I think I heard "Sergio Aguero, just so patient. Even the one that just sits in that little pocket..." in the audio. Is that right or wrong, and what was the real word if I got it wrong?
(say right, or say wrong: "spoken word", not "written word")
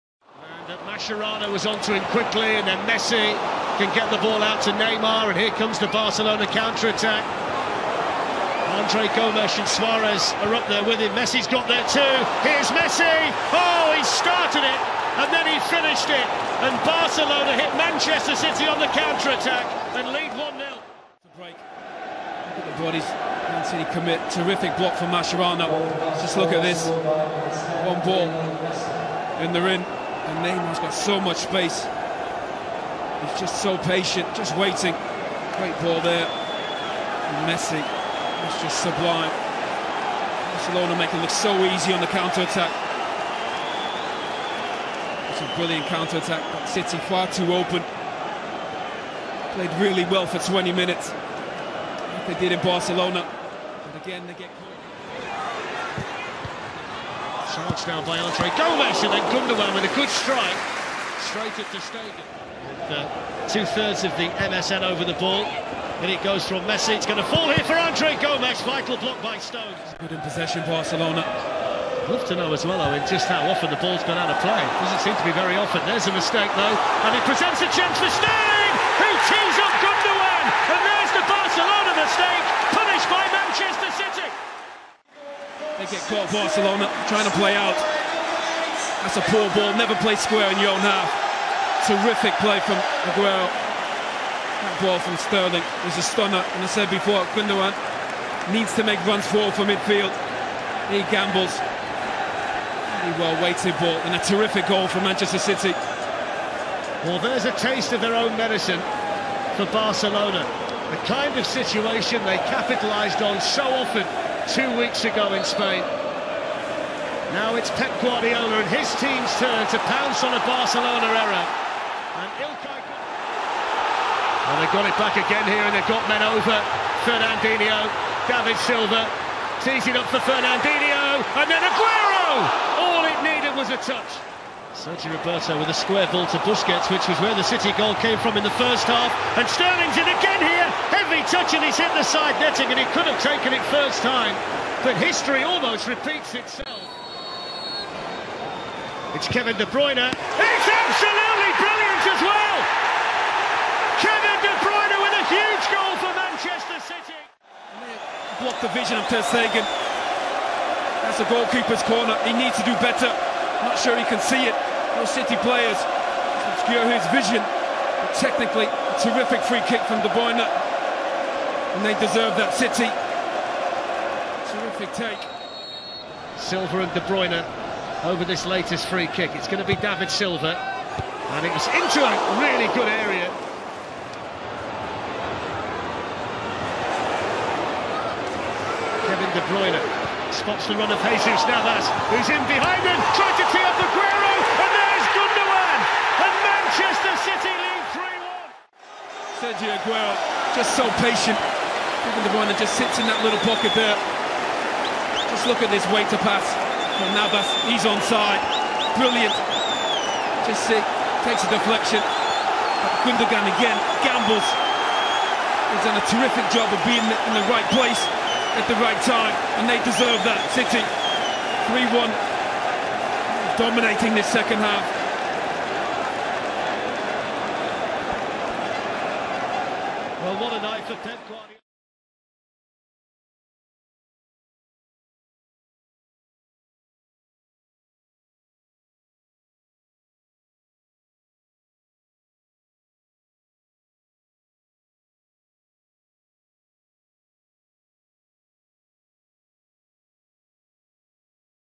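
right.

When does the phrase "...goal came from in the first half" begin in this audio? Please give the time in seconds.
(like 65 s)
137 s.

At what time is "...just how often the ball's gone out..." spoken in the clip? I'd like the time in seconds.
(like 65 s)
73 s.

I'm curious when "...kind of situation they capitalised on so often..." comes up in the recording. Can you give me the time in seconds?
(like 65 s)
111 s.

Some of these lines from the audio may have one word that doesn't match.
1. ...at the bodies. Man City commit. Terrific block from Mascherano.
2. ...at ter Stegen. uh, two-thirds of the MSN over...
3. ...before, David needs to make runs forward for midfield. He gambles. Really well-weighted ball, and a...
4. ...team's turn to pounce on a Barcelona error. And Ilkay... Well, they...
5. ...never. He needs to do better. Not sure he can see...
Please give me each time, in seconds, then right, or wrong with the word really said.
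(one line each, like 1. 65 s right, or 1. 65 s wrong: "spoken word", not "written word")
1. 21 s right
2. 61 s right
3. 96 s wrong: "Gundogan", not "David"
4. 118 s right
5. 161 s wrong: "corner", not "never".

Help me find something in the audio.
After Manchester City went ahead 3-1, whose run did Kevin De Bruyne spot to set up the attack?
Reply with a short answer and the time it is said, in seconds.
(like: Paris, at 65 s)
Jesus Navas, at 191 s.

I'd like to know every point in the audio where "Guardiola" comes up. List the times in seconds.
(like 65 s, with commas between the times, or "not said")
118 s, 231 s.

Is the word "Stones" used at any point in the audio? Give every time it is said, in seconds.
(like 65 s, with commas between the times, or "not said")
69 s, 78 s.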